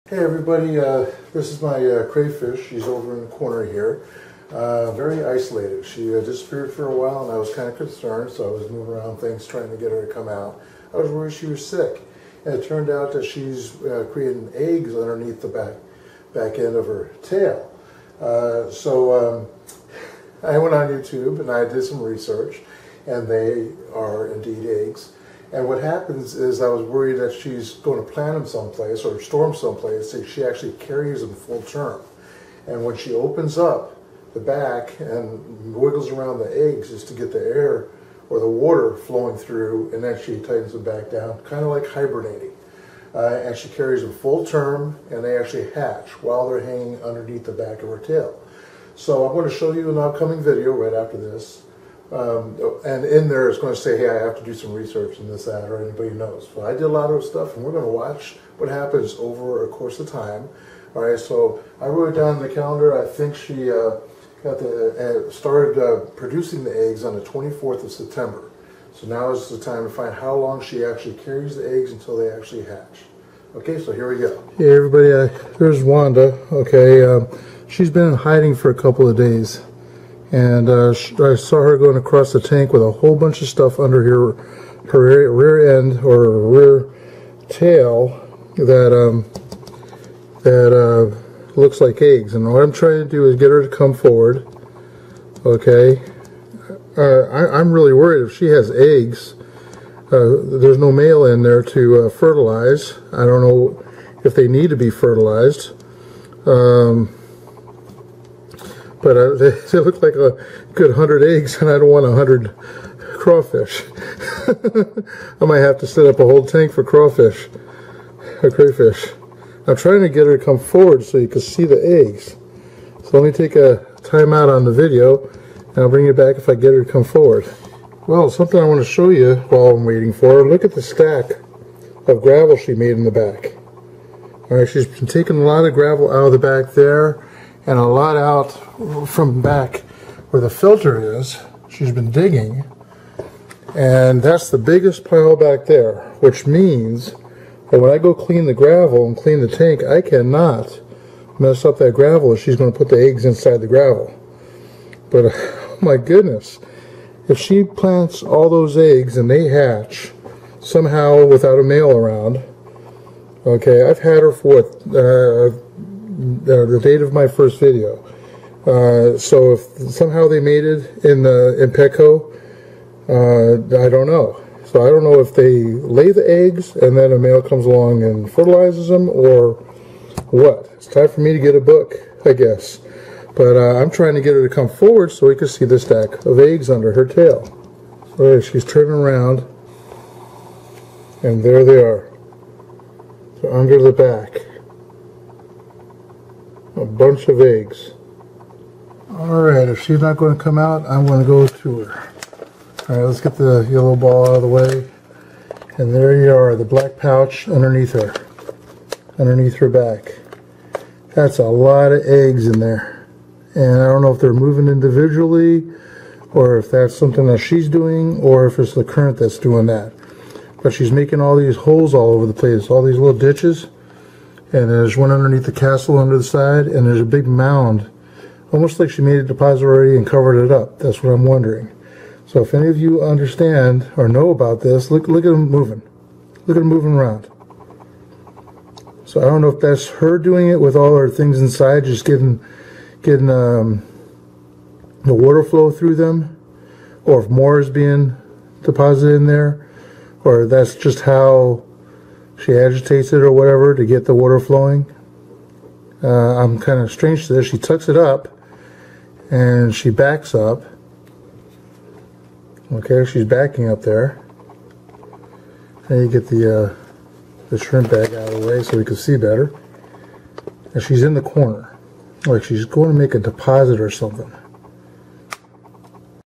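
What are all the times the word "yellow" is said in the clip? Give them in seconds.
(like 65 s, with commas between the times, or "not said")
203 s.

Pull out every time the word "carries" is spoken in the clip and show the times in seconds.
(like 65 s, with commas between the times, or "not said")
30 s, 43 s, 71 s.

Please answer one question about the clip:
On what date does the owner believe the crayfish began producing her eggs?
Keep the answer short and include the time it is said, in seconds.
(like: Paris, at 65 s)
September 24, at 67 s.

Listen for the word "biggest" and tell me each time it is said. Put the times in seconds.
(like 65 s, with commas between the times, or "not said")
144 s.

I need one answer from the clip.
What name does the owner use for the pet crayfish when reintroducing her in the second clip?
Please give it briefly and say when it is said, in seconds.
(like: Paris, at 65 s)
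Wanda, at 75 s.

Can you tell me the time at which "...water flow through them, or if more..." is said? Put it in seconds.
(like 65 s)
245 s.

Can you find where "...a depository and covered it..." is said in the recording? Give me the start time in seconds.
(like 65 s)
229 s.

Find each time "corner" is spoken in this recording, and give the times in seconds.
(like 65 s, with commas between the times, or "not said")
3 s, 271 s.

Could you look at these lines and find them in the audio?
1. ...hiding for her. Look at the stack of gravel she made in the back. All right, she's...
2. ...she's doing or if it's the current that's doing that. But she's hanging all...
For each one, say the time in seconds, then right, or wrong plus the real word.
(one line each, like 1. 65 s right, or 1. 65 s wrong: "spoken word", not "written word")
1. 129 s wrong: "waiting", not "hiding"
2. 217 s wrong: "making", not "hanging".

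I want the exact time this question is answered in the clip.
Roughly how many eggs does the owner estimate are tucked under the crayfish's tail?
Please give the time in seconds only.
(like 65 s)
110 s.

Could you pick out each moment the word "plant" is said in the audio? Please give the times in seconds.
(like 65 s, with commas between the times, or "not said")
28 s, 157 s.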